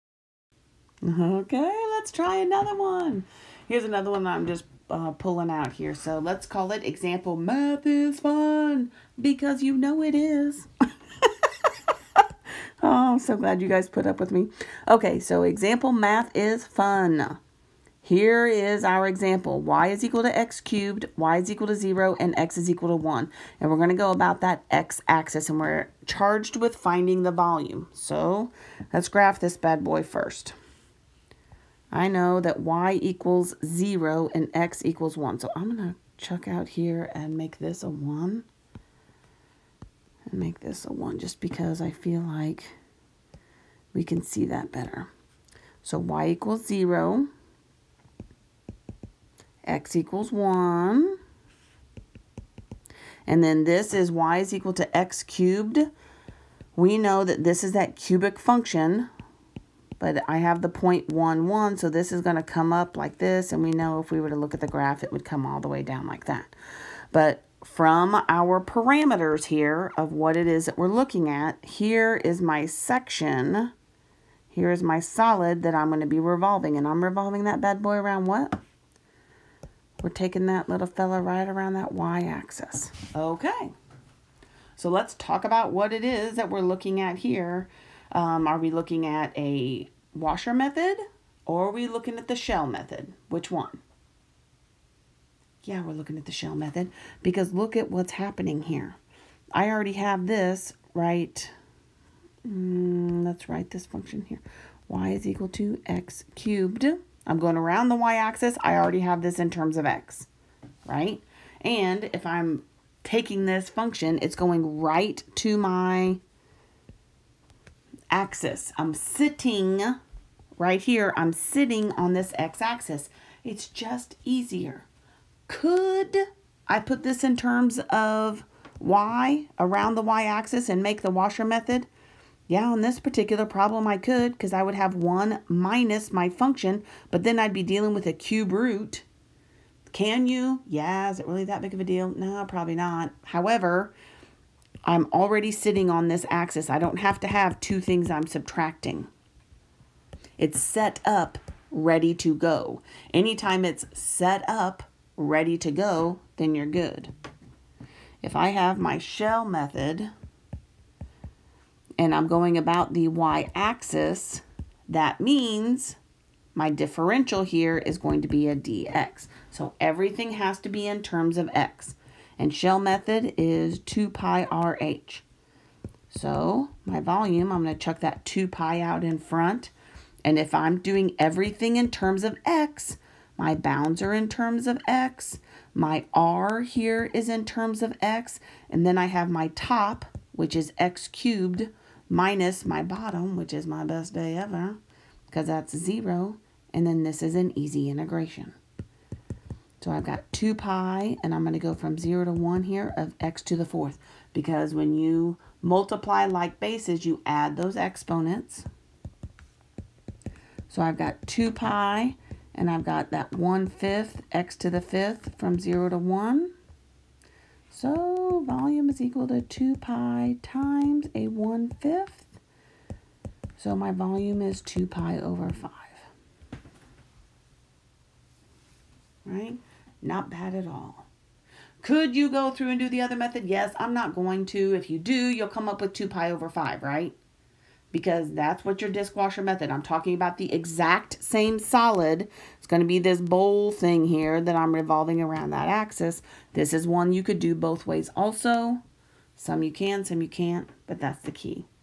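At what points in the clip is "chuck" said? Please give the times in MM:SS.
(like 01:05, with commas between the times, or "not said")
00:36, 02:57.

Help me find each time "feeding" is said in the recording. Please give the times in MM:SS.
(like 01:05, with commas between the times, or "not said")
not said.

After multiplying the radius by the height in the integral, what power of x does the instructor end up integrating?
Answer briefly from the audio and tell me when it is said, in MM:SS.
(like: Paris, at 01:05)
x to the fourth, at 03:23.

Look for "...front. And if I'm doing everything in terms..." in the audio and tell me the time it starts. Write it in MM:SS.
02:59.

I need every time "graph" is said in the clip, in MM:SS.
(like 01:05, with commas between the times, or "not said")
00:29, 01:04.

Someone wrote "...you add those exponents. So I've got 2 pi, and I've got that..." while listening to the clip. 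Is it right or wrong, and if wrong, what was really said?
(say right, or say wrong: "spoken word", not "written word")
right.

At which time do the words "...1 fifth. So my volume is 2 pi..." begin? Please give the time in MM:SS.
03:41.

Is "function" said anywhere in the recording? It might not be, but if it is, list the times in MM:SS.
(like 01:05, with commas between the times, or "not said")
00:58, 01:43, 01:53, 02:16.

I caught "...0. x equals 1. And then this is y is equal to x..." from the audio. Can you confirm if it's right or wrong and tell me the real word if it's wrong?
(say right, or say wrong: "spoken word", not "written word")
right.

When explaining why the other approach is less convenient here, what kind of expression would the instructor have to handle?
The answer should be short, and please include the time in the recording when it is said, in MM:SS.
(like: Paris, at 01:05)
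cube root, at 02:18.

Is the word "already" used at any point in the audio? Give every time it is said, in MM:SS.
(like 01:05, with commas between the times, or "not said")
01:39, 01:48, 02:25.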